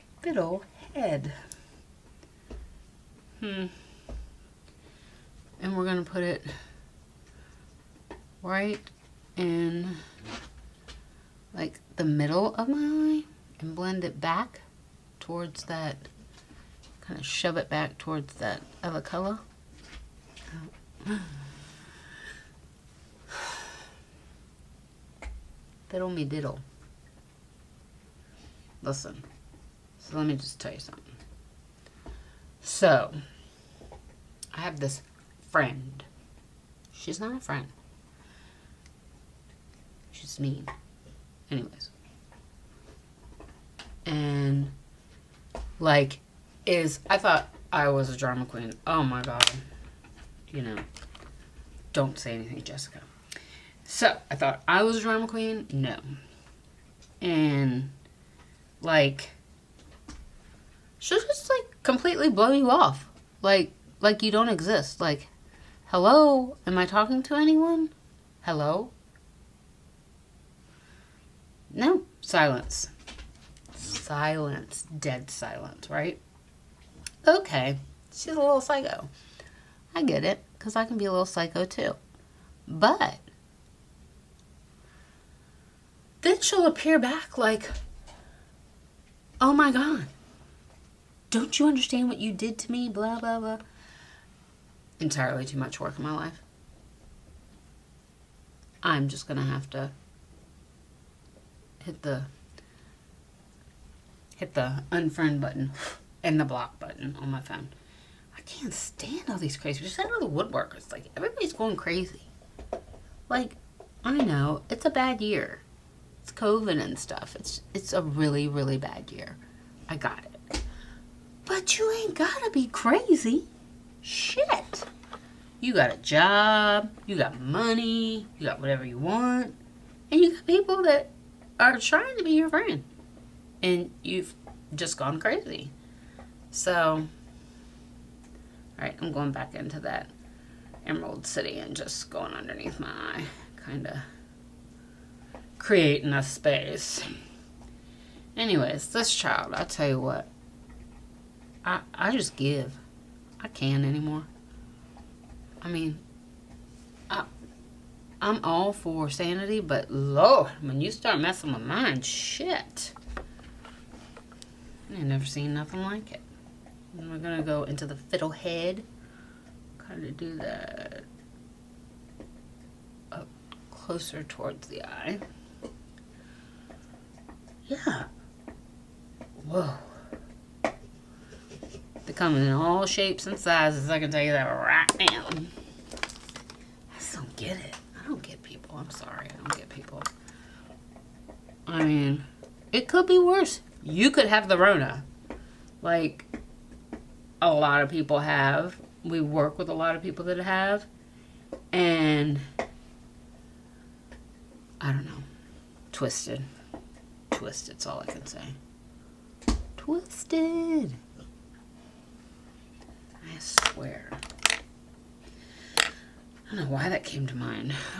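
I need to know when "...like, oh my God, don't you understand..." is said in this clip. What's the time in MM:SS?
01:27.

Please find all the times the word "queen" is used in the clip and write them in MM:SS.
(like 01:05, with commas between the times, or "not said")
00:48, 00:55.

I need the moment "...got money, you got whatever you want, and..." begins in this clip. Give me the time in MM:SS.
02:07.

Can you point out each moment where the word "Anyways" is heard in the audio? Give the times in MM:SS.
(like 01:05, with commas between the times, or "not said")
00:41, 02:28.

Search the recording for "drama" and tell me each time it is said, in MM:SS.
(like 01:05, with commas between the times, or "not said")
00:48, 00:55.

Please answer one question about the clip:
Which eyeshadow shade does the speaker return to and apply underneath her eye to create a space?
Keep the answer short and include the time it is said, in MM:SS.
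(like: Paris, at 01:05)
Emerald City, at 02:20.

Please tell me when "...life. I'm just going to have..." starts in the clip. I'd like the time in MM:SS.
01:36.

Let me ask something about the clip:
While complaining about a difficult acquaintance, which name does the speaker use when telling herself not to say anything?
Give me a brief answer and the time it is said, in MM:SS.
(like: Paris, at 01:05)
Jessica, at 00:52.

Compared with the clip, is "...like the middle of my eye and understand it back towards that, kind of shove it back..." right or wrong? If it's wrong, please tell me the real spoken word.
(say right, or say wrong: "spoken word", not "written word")
wrong: "blend", not "understand".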